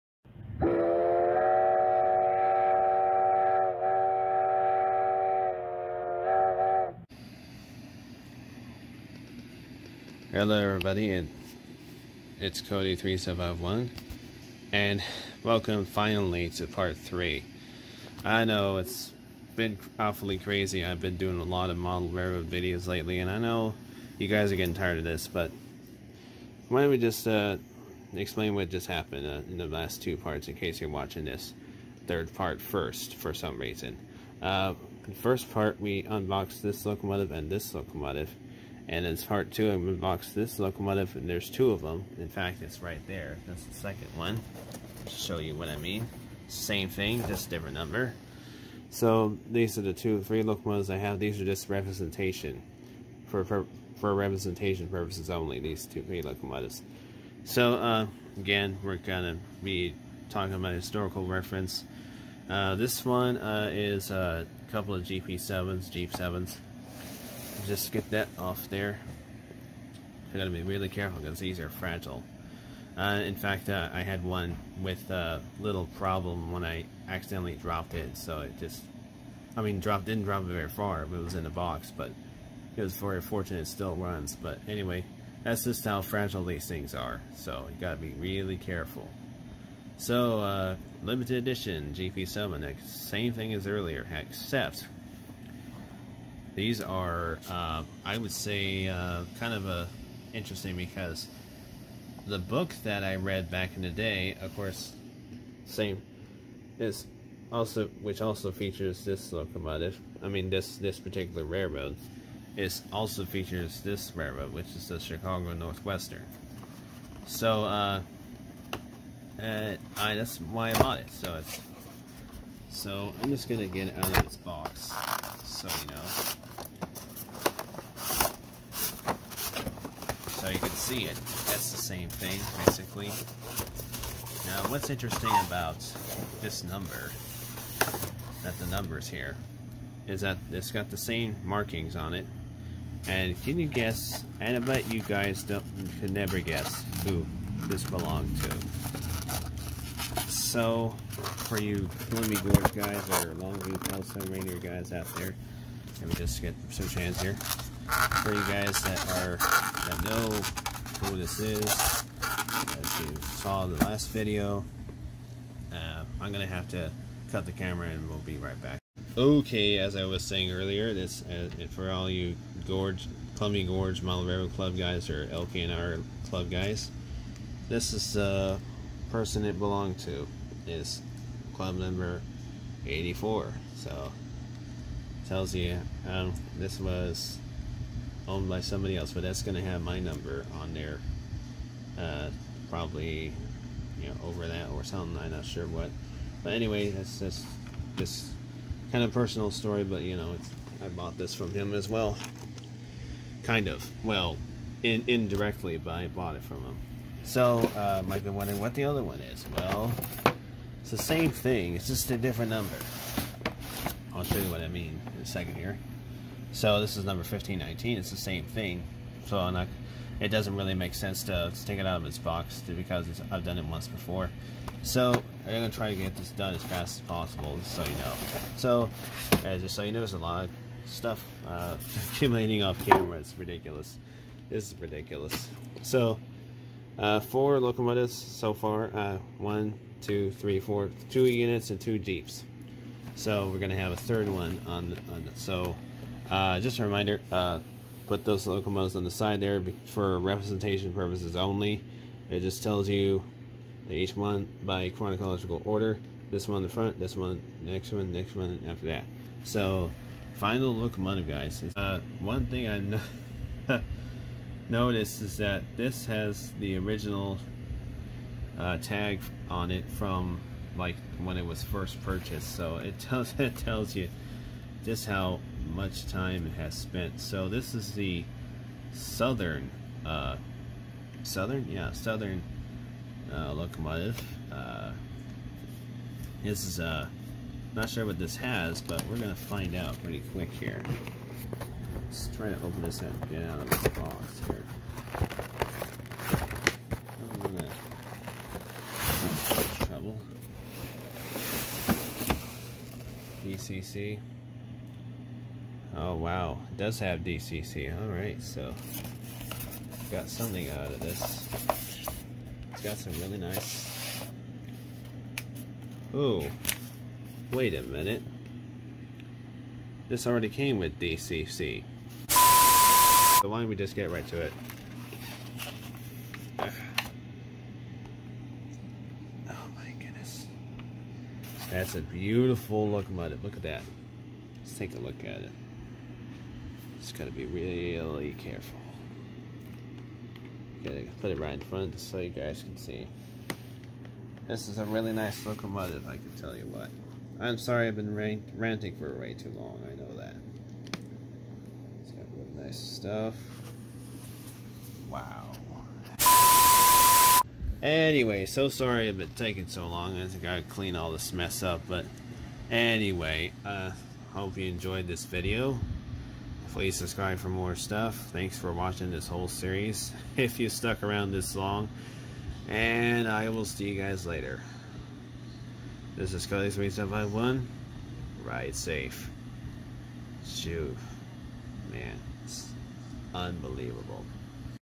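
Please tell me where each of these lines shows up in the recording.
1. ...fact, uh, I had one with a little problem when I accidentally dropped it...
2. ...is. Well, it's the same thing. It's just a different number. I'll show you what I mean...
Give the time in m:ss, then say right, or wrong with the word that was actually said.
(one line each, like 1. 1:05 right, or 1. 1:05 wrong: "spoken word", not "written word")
1. 1:13 right
2. 3:29 right.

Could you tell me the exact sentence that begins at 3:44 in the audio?
So I'm going to try to get this done as fast as possible just so you know.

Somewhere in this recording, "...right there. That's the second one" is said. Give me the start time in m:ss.
0:42.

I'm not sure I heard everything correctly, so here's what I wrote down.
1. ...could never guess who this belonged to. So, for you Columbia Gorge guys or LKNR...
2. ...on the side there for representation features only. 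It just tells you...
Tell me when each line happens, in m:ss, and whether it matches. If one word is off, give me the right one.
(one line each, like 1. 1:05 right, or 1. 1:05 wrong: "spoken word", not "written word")
1. 2:26 wrong: "Longview", not "LKNR"
2. 4:08 wrong: "purposes", not "features".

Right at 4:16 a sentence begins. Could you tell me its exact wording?
This one in the front, this one, next one, next one, after that.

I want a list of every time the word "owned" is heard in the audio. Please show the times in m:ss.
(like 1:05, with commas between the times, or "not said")
3:08.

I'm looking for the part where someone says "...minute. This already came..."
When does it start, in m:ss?
5:17.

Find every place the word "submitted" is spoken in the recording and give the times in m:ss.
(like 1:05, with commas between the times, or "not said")
not said.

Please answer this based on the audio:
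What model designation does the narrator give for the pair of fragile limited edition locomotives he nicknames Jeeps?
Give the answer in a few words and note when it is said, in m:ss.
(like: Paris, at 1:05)
GP7, at 1:05.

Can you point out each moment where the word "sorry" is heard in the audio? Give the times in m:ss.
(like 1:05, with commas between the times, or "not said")
5:47, 5:58.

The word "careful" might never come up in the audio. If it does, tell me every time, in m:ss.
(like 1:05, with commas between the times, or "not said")
1:10, 1:28, 5:38.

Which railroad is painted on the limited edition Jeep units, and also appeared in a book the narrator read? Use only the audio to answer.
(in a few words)
Chicago Northwestern.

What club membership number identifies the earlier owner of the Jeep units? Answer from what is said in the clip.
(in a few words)
84.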